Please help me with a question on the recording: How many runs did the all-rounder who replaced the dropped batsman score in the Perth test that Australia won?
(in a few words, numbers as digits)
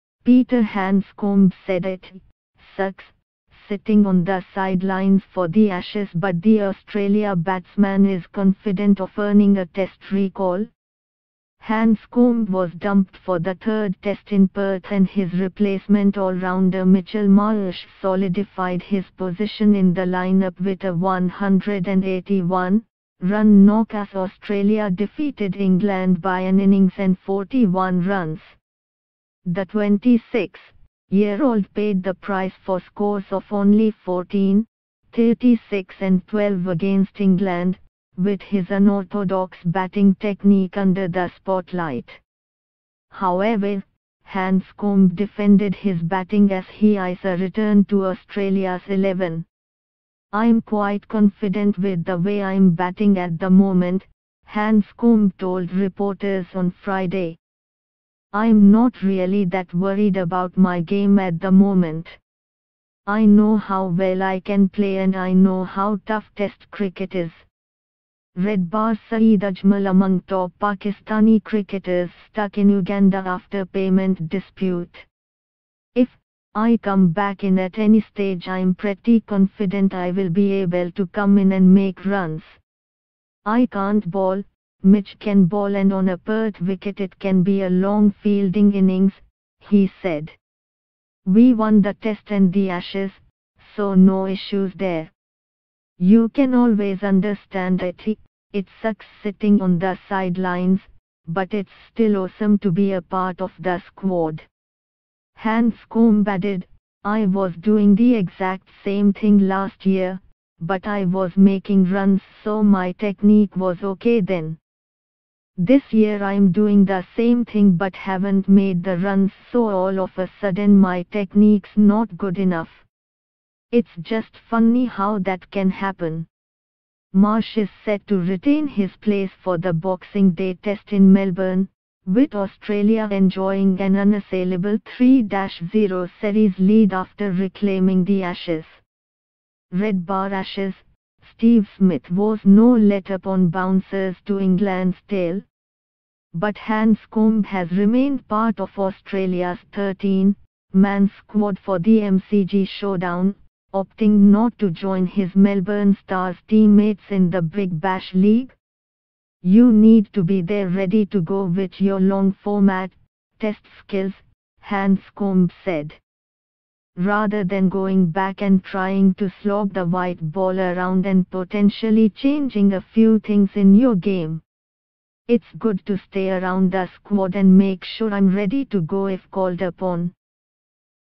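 181.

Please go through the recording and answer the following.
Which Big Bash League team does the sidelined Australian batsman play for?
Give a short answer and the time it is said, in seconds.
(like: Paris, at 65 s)
Melbourne Stars, at 155 s.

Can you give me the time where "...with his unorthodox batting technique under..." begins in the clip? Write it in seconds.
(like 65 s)
38 s.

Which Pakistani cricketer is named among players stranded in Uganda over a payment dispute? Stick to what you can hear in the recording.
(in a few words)
Saeed Ajmal.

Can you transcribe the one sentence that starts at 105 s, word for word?
Handscomb added, I was doing the exact same thing last year, but I was making runs so my technique was okay then.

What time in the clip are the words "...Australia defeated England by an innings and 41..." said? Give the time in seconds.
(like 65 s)
24 s.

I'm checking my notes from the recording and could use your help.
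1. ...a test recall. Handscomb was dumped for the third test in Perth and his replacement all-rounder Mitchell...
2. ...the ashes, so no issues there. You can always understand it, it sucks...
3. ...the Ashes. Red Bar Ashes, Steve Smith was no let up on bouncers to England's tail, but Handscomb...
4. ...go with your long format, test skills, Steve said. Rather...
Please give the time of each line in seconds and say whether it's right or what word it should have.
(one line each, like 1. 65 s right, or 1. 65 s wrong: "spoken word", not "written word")
1. 9 s right
2. 92 s right
3. 138 s right
4. 161 s wrong: "Handscomb", not "Steve".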